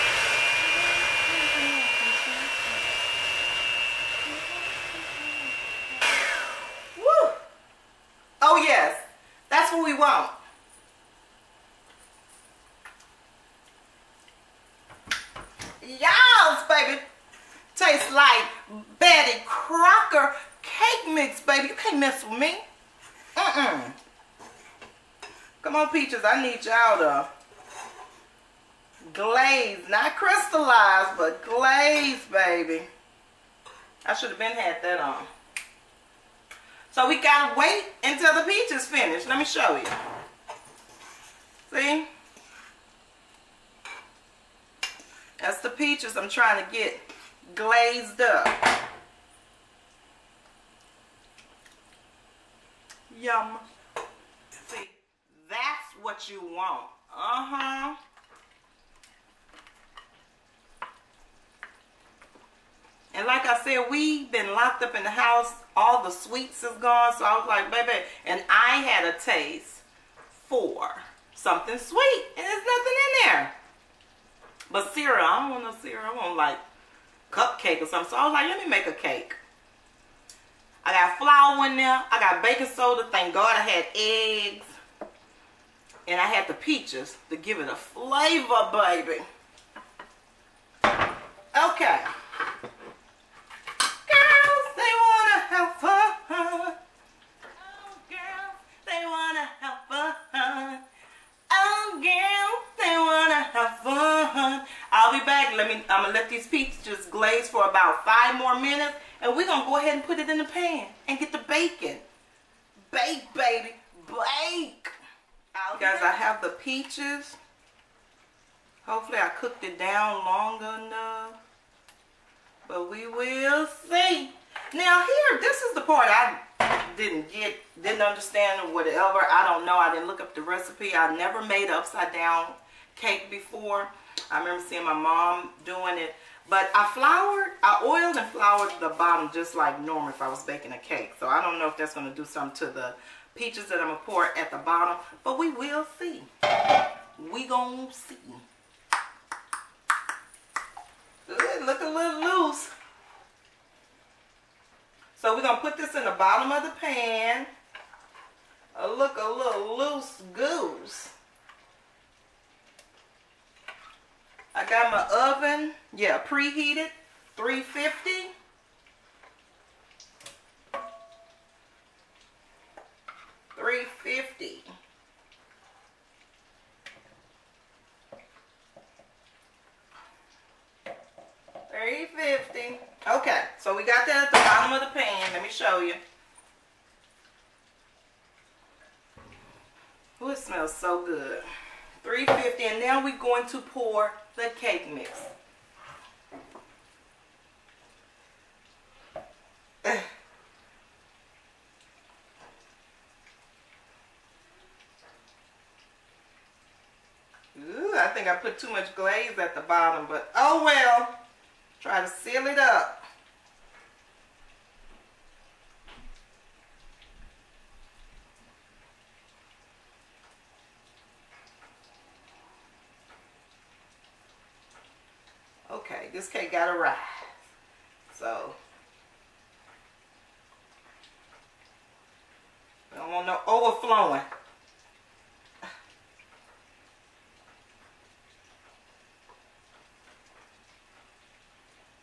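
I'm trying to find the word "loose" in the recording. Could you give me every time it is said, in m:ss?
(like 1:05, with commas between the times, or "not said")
2:32, 2:39.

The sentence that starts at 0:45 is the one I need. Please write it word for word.
That's the peaches I'm trying to get glazed up.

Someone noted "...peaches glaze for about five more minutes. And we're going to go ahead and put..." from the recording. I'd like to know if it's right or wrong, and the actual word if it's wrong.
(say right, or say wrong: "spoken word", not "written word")
right.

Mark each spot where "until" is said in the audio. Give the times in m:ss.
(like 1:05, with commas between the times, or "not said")
0:38.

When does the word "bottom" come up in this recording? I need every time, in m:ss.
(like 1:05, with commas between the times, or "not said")
2:18, 2:24, 2:36, 3:04, 3:29.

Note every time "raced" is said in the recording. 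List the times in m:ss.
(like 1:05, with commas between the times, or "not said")
not said.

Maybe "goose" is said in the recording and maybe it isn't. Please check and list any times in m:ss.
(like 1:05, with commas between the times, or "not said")
2:40.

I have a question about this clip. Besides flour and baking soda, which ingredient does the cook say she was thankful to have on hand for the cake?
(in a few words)
eggs.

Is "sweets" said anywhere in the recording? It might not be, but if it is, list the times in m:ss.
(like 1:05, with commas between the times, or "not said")
1:06, 1:11.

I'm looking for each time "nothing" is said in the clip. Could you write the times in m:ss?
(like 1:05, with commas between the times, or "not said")
1:12.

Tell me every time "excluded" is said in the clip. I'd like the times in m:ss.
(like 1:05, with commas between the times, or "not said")
not said.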